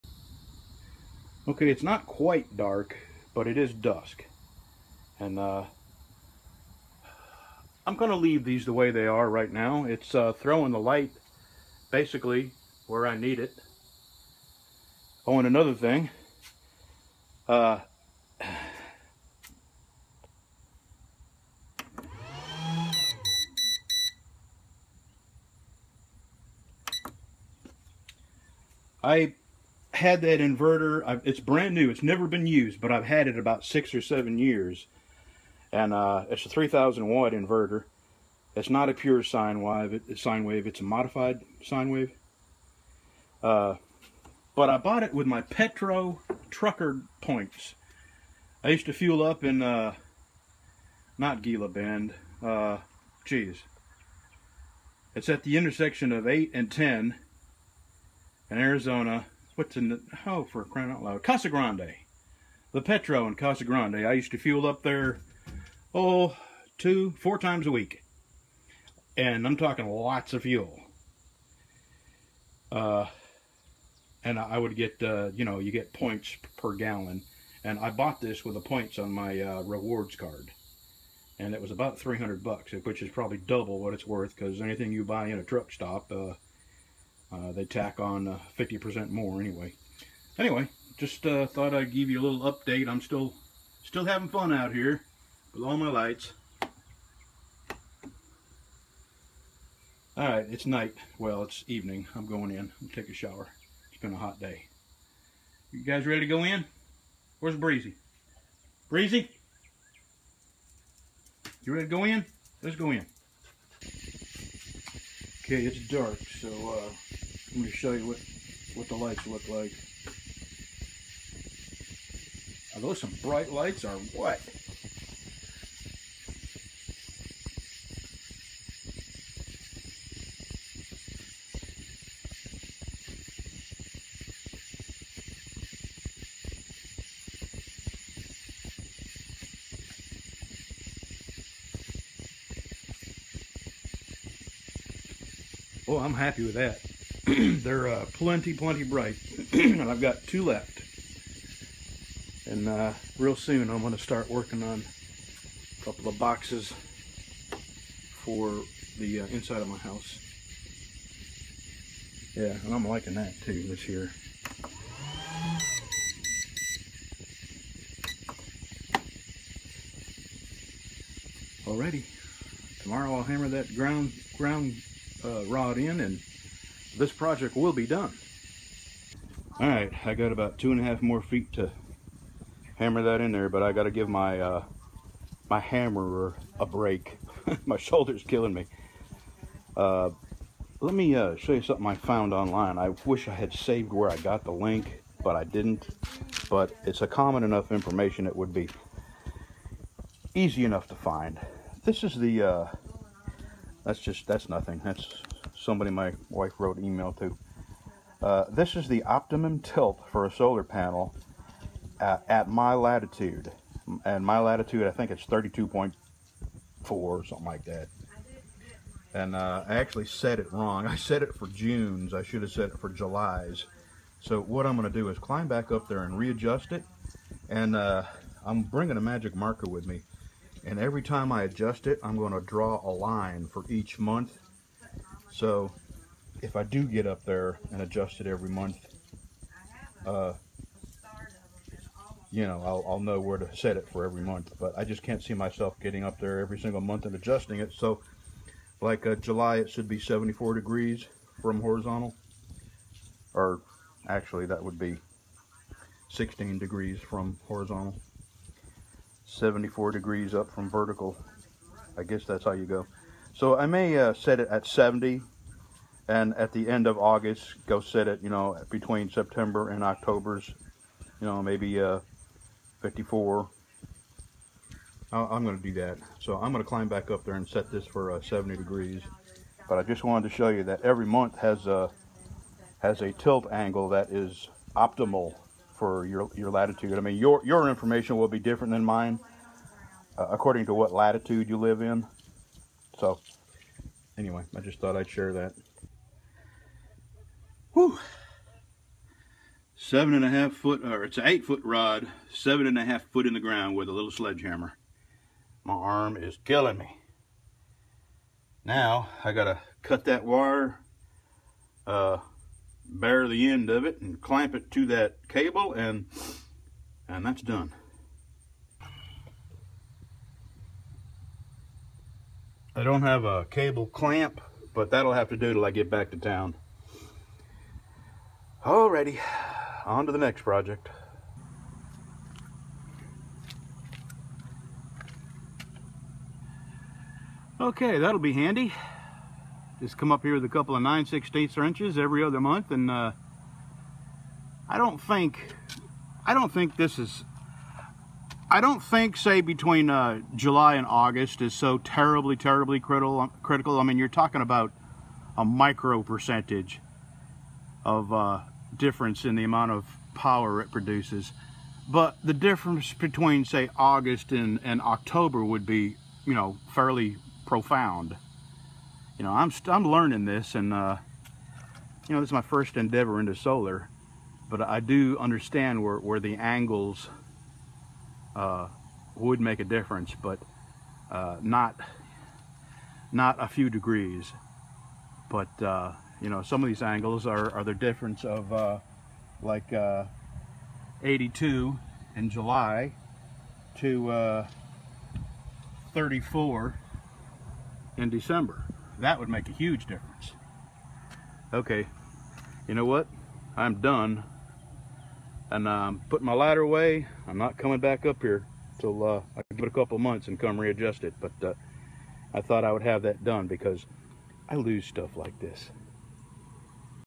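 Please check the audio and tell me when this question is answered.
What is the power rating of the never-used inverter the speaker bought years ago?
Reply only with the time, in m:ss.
0:36.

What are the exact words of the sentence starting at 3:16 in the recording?
But it's a common enough information it would be easy enough to find.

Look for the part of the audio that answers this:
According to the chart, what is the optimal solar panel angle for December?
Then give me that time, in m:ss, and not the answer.
6:35.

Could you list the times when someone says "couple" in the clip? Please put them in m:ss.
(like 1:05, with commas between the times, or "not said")
2:35, 5:40, 6:49.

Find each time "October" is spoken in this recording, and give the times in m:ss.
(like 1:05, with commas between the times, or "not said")
4:29, 6:04.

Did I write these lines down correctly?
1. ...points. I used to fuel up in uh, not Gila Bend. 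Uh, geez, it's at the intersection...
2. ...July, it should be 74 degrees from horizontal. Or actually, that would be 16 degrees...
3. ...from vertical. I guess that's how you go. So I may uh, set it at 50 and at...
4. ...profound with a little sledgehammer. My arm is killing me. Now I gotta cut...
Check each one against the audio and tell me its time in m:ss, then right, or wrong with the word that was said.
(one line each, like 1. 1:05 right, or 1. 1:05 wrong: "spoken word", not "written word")
1. 0:47 right
2. 4:09 right
3. 4:20 wrong: "70", not "50"
4. 5:03 wrong: "ground", not "profound".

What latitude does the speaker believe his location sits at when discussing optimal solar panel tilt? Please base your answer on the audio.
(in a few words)
32.4.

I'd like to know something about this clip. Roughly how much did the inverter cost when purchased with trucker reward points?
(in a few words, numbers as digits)
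$300.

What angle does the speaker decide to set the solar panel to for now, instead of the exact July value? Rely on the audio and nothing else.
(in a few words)
70 degrees.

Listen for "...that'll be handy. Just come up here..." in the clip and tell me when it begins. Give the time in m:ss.
5:37.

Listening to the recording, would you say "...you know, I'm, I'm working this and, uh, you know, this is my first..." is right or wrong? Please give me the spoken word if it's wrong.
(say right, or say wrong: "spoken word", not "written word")
wrong: "learning", not "working".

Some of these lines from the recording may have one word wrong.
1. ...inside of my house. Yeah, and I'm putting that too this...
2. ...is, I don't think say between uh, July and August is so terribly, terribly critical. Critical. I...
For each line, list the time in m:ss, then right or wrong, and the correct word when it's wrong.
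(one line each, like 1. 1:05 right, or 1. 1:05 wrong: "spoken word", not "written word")
1. 2:39 wrong: "liking", not "putting"
2. 5:46 right.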